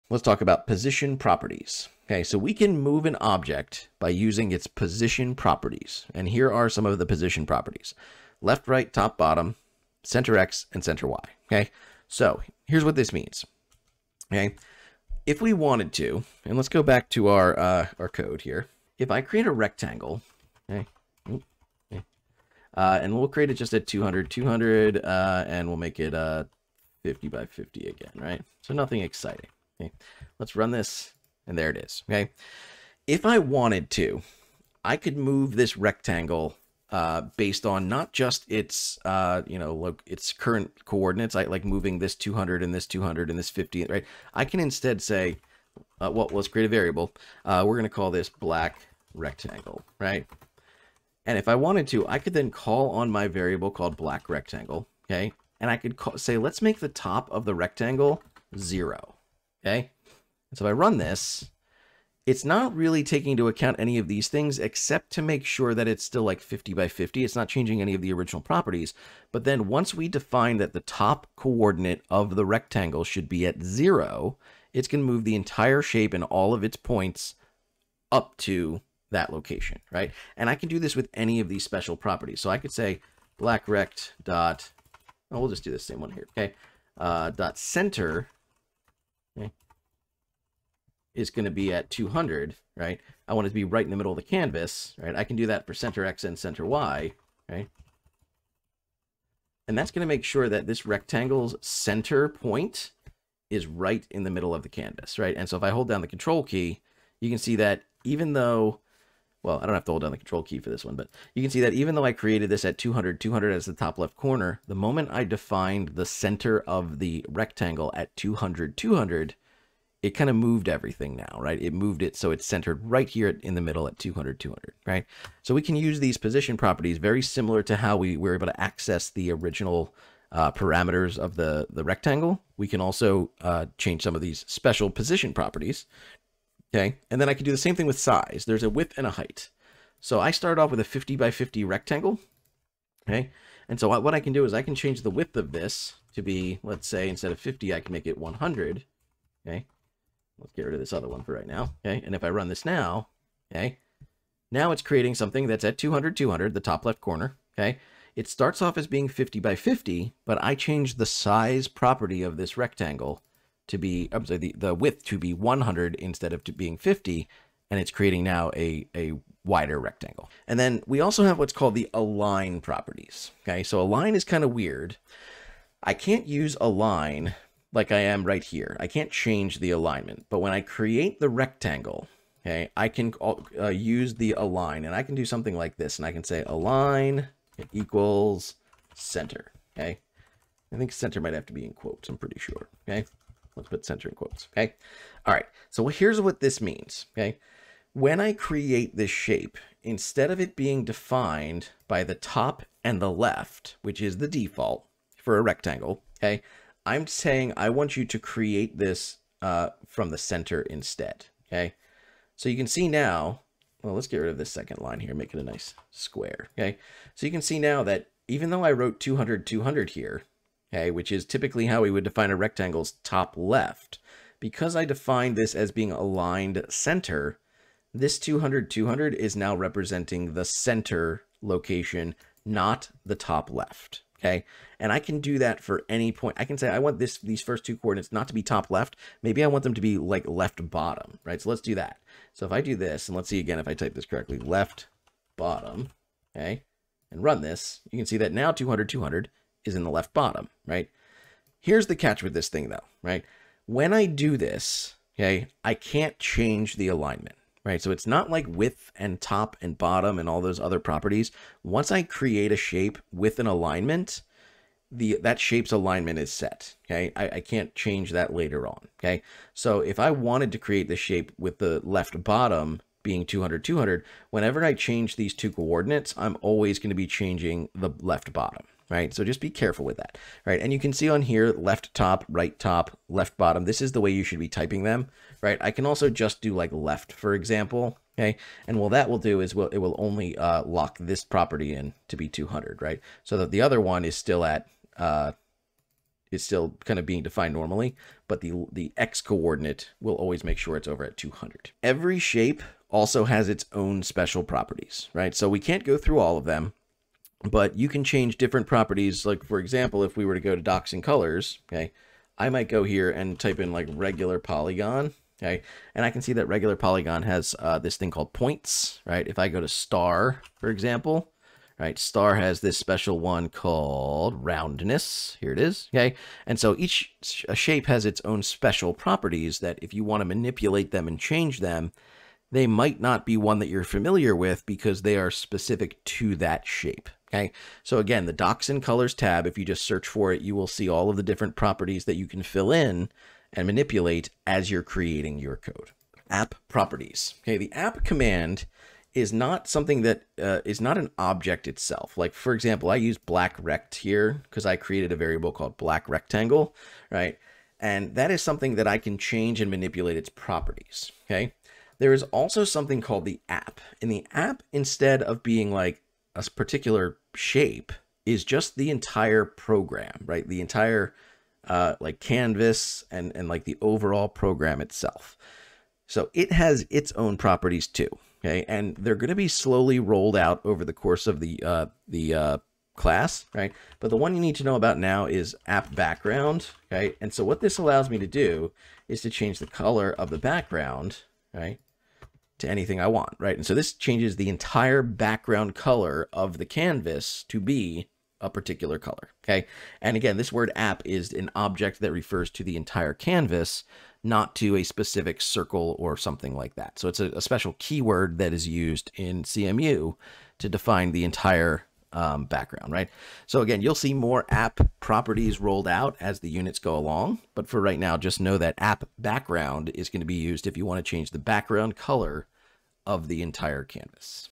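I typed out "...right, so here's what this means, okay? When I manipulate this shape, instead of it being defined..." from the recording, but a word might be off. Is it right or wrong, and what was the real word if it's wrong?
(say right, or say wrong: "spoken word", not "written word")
wrong: "create", not "manipulate".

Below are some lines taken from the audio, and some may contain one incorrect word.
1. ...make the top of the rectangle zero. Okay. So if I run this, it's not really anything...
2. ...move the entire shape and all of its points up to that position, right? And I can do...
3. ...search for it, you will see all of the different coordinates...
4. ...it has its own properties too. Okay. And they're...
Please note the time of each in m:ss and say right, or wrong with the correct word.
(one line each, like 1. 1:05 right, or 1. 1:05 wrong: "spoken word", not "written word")
1. 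0:56 wrong: "taking", not "anything"
2. 1:15 wrong: "location", not "position"
3. 5:39 wrong: "properties", not "coordinates"
4. 6:16 right.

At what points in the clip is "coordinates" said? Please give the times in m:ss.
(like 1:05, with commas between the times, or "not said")
0:40, 1:11, 3:57, 4:35, 4:59.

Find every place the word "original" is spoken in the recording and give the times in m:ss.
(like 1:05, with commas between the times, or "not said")
1:08, 2:09.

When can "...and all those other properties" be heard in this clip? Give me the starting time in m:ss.
4:20.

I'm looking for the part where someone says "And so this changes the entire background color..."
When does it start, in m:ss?
6:33.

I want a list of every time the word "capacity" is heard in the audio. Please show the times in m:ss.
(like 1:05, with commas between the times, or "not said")
not said.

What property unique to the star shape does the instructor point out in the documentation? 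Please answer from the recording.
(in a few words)
roundness.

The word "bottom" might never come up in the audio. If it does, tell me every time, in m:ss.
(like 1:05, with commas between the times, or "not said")
0:09, 4:00, 4:05, 4:10, 4:19, 4:32, 4:38, 4:43.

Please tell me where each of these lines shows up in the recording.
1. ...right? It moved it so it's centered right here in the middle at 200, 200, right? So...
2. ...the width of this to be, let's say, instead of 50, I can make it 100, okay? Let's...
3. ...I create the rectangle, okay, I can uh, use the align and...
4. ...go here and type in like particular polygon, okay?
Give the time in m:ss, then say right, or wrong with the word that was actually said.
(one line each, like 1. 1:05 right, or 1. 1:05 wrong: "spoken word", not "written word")
1. 2:01 right
2. 2:25 right
3. 3:00 right
4. 5:12 wrong: "regular", not "particular".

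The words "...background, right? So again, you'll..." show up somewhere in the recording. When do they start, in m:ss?
6:52.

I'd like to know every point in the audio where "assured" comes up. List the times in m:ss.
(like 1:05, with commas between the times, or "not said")
not said.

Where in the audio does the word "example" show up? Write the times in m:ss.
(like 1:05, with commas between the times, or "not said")
4:47, 5:09, 5:20, 5:52.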